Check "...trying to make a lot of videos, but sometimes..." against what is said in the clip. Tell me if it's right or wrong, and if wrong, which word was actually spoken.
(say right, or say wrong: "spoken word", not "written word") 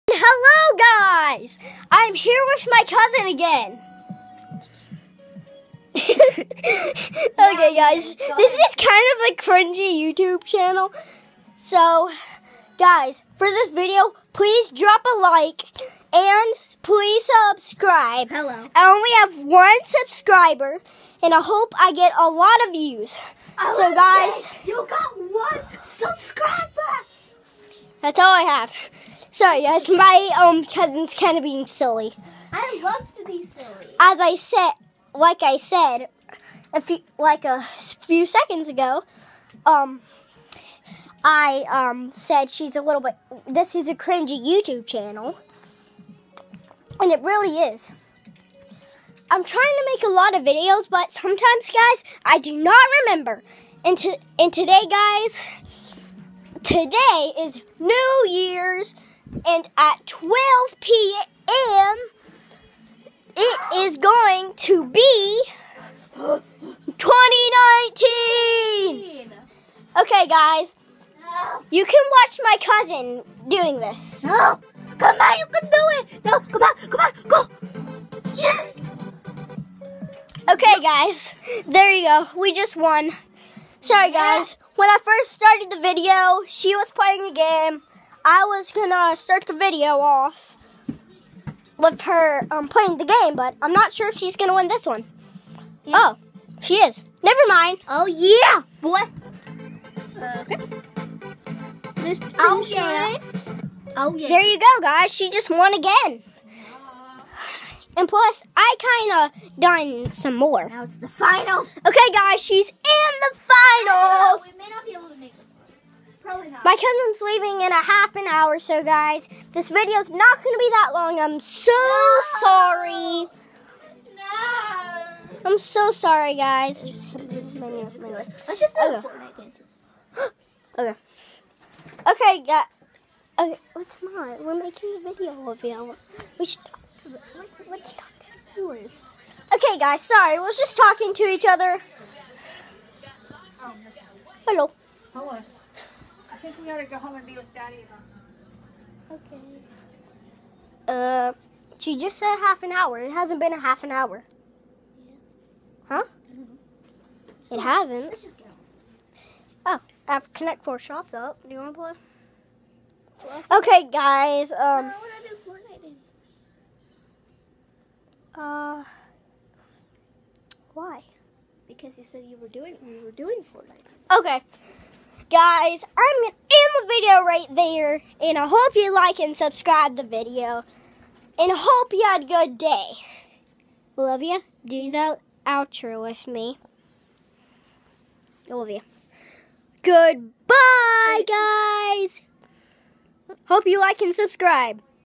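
right.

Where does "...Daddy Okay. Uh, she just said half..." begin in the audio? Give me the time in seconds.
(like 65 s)
147 s.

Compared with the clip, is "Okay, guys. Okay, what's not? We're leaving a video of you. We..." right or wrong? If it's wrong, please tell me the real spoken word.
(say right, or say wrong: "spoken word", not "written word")
wrong: "making", not "leaving".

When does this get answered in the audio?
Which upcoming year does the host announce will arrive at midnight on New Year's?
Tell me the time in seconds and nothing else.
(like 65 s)
66 s.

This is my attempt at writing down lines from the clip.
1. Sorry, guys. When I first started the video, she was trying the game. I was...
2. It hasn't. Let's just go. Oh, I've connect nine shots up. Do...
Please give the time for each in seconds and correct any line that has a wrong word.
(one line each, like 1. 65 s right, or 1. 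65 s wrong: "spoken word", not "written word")
1. 83 s wrong: "playing", not "trying"
2. 157 s wrong: "four", not "nine".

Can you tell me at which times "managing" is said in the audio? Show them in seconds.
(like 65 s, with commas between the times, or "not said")
not said.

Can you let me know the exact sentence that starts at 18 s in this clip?
I only have one subscriber, and I hope I get a lot of views.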